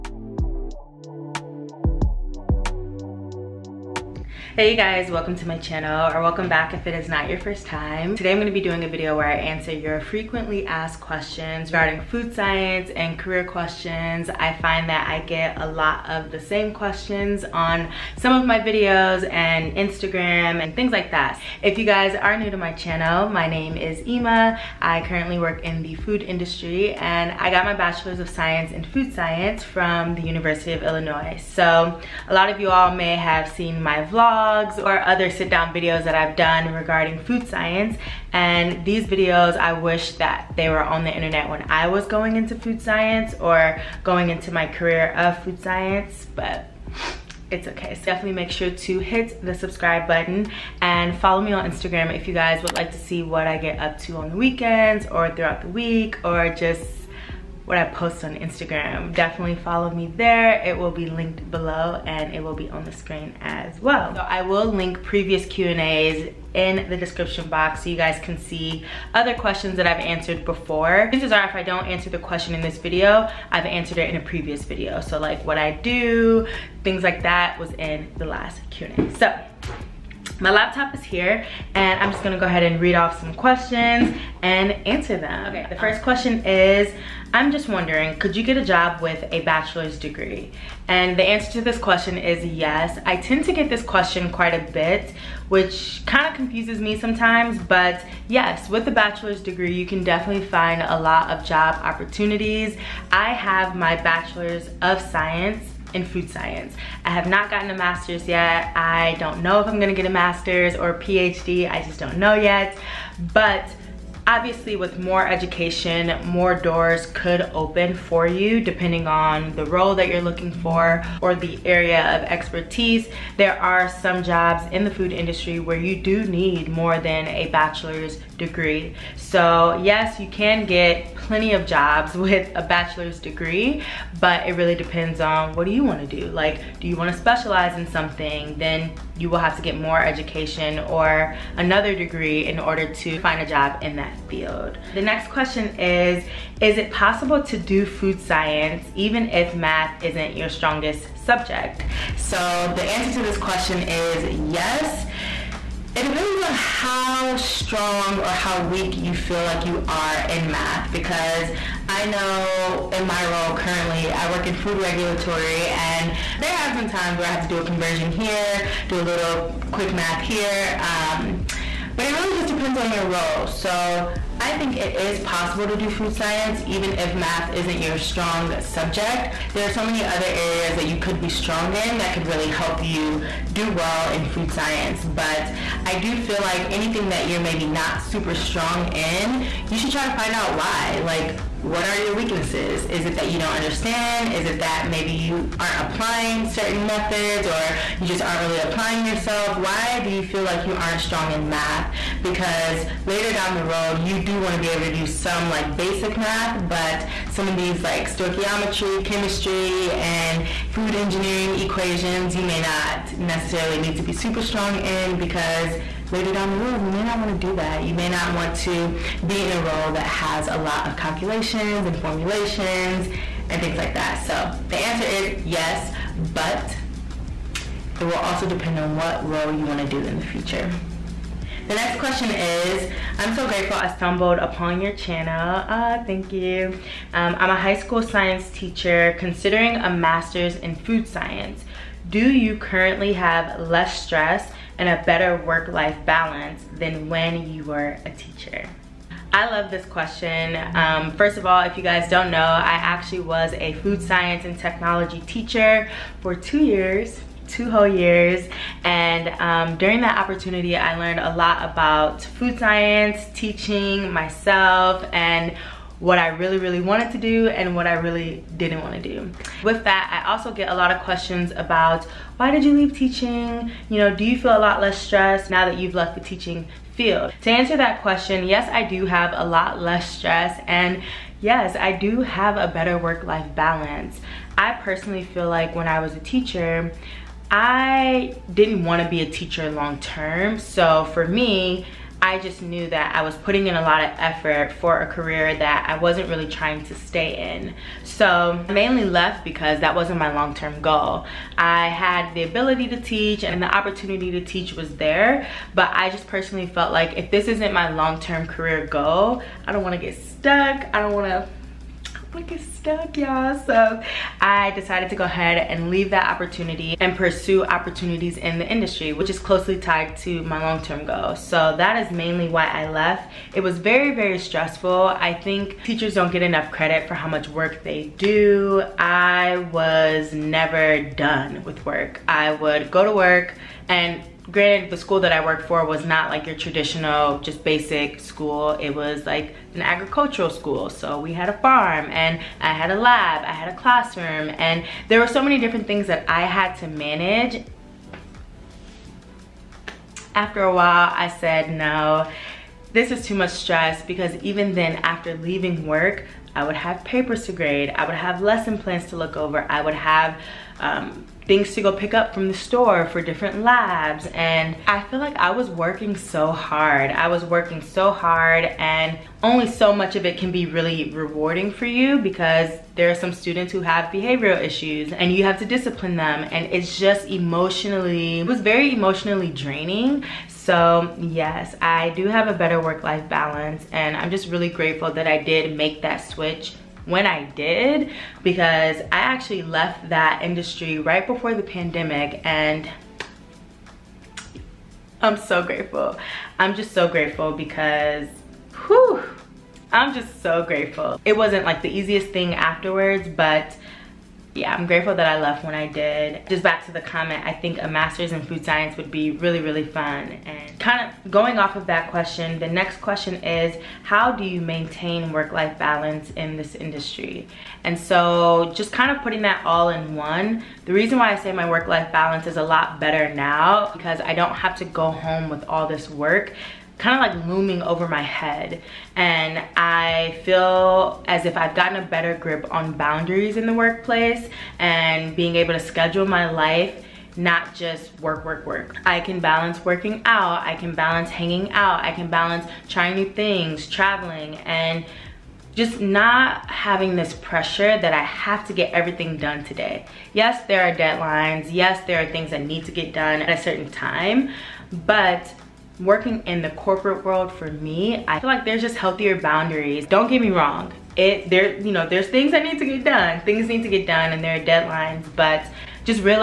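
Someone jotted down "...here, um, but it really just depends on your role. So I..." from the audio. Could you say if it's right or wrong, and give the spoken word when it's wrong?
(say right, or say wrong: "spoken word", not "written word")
right.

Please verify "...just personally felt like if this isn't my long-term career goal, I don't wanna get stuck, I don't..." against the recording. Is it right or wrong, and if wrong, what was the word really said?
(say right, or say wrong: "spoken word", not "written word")
right.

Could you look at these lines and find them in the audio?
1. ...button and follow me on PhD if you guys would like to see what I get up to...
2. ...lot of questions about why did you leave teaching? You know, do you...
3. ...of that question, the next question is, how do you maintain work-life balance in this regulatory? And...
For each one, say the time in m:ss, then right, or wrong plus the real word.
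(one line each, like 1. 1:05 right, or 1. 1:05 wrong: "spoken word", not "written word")
1. 0:50 wrong: "Instagram", not "PhD"
2. 4:30 right
3. 6:51 wrong: "industry", not "regulatory".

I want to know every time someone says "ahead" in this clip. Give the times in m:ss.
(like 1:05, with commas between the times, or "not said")
1:22, 5:15.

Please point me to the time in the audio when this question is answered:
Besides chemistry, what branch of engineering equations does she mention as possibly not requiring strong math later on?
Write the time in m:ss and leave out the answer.
3:30.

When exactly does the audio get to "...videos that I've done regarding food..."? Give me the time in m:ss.
0:35.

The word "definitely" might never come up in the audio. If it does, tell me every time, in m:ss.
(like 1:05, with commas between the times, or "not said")
0:48, 0:59, 1:40.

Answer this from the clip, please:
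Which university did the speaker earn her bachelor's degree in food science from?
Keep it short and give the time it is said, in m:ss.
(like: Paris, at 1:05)
University of Illinois, at 0:30.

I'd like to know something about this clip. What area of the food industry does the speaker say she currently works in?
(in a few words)
Food regulatory.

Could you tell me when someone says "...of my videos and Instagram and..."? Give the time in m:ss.
0:18.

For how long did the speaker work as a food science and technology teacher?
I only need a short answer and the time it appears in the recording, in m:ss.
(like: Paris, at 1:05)
2 years, at 4:16.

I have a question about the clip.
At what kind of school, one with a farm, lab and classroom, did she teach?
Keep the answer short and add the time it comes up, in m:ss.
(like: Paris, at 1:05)
Agricultural school, at 5:39.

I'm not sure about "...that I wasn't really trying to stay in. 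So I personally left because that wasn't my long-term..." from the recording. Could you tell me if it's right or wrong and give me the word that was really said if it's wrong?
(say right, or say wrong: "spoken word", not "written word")
wrong: "mainly", not "personally".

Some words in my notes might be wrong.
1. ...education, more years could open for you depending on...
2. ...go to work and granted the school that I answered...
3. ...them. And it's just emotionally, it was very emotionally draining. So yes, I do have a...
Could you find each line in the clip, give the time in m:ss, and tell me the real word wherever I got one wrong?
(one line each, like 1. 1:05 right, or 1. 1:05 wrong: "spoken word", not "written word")
1. 1:55 wrong: "doors", not "years"
2. 5:32 wrong: "worked", not "answered"
3. 6:16 right.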